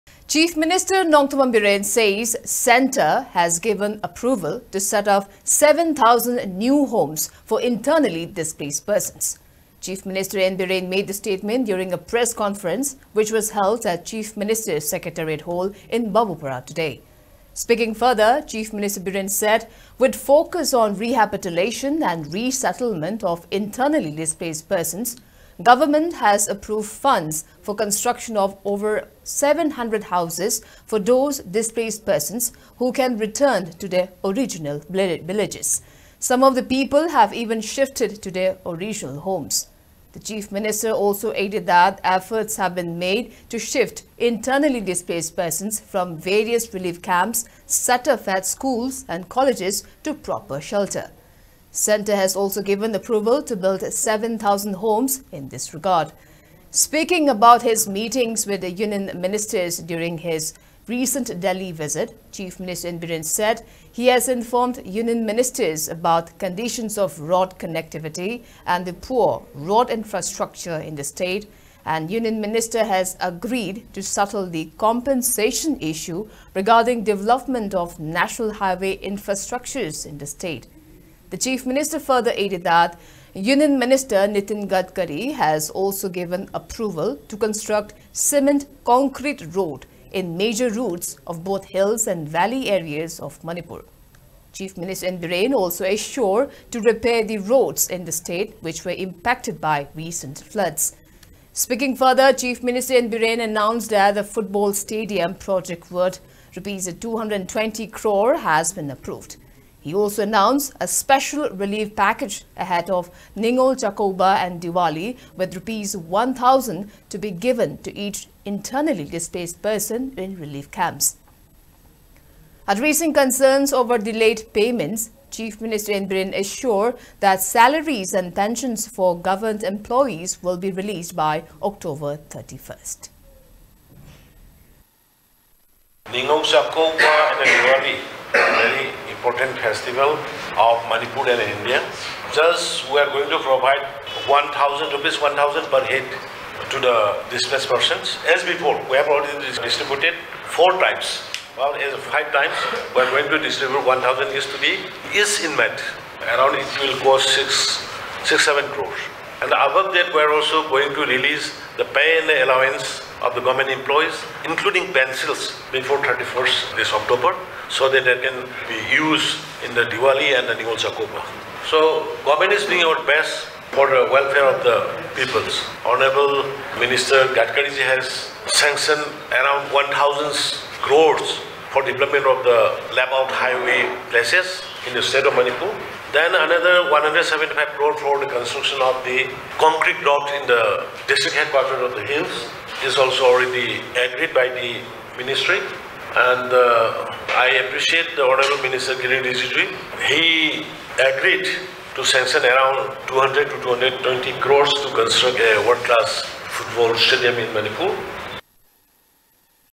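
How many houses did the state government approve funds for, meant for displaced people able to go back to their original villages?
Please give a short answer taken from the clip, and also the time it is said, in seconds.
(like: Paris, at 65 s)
over 700, at 28 s.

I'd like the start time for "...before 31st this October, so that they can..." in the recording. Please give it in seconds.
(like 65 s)
165 s.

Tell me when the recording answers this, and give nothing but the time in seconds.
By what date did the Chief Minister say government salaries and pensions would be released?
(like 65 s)
131 s.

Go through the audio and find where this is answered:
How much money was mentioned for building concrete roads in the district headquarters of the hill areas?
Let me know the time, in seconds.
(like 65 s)
186 s.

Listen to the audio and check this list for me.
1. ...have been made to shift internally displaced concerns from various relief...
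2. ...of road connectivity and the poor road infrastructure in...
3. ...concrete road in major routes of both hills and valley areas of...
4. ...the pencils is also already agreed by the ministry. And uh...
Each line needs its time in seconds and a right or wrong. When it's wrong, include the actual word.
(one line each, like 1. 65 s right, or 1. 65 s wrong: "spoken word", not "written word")
1. 42 s wrong: "persons", not "concerns"
2. 66 s right
3. 88 s right
4. 191 s wrong: "hills", not "pencils".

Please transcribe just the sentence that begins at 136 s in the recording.
Ningong and the important festival of Manipur and India.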